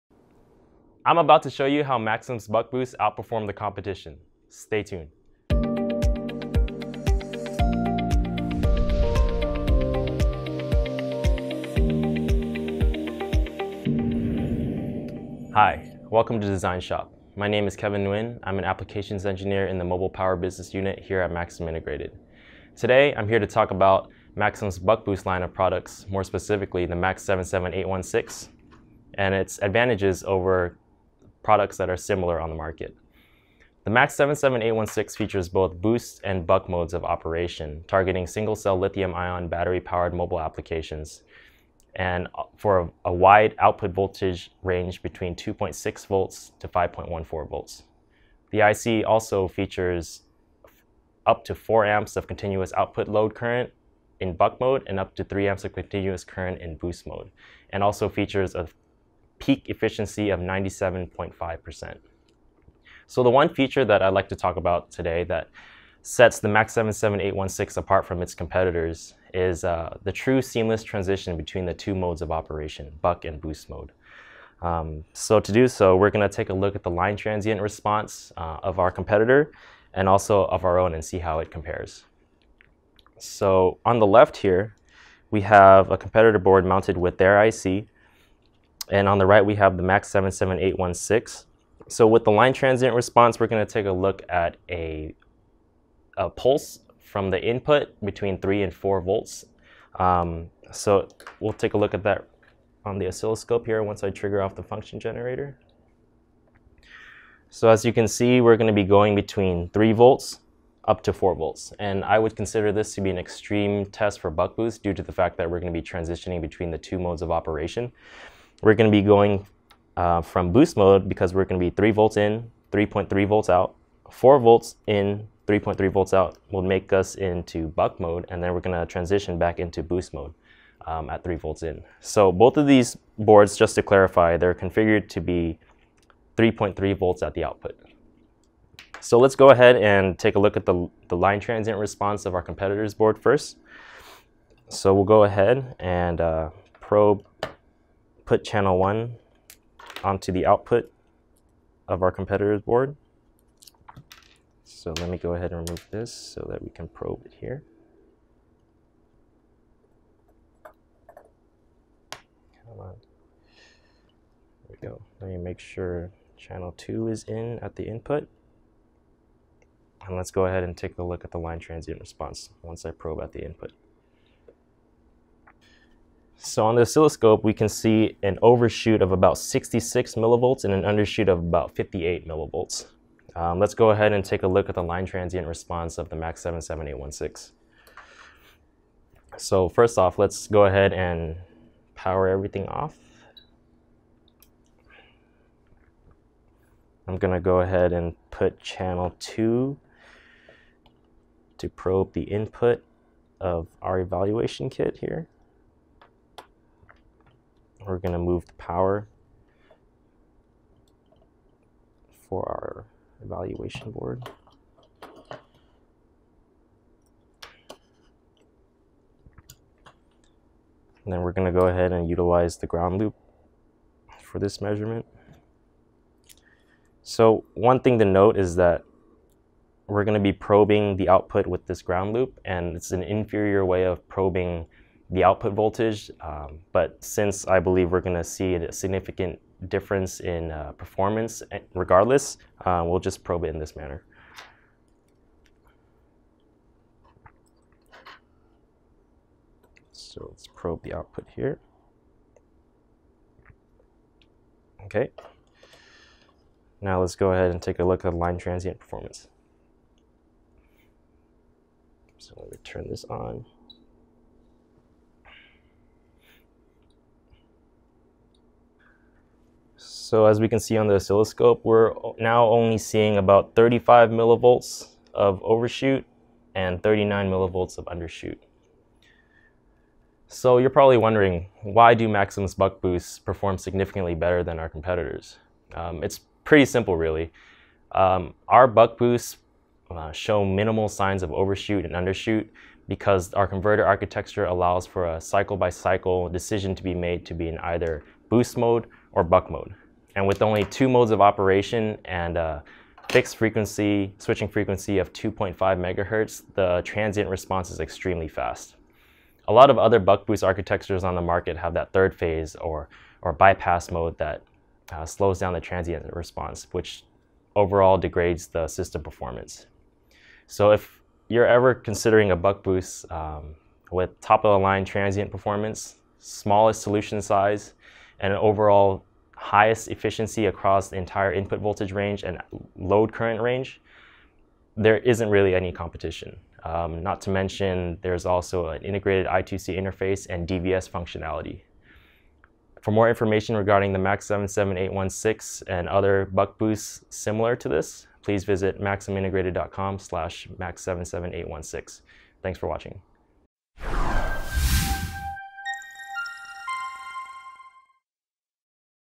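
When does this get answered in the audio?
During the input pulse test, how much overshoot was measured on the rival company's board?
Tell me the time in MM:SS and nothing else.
02:59.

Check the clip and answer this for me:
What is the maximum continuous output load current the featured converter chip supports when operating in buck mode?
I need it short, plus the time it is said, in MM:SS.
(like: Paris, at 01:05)
4 amps, at 00:51.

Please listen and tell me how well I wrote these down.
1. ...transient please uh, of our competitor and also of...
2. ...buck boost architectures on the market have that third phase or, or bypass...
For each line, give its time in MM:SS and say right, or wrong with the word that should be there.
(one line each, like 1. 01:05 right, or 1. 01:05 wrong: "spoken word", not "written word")
1. 01:17 wrong: "response", not "please"
2. 05:09 right.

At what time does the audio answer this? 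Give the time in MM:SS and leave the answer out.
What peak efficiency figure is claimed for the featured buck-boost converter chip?
01:00.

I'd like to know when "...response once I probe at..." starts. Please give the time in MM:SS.
02:51.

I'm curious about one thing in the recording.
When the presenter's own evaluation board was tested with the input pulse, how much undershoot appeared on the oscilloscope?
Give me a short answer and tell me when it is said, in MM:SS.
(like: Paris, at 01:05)
39 millivolts, at 04:36.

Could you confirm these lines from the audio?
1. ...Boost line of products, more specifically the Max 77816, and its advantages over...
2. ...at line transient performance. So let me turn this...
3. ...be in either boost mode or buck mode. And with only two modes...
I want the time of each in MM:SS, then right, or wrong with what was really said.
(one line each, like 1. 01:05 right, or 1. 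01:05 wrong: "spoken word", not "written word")
1. 00:25 right
2. 04:18 right
3. 04:57 right.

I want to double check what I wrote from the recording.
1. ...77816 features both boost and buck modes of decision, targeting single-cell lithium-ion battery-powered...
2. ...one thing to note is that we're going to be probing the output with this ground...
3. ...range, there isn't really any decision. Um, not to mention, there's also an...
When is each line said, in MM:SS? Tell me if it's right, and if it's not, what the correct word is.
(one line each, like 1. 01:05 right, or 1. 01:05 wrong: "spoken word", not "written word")
1. 00:34 wrong: "operation", not "decision"
2. 03:47 right
3. 05:33 wrong: "competition", not "decision".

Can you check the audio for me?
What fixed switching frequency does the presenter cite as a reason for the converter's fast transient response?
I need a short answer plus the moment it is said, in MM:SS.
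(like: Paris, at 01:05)
2.5 megahertz, at 05:05.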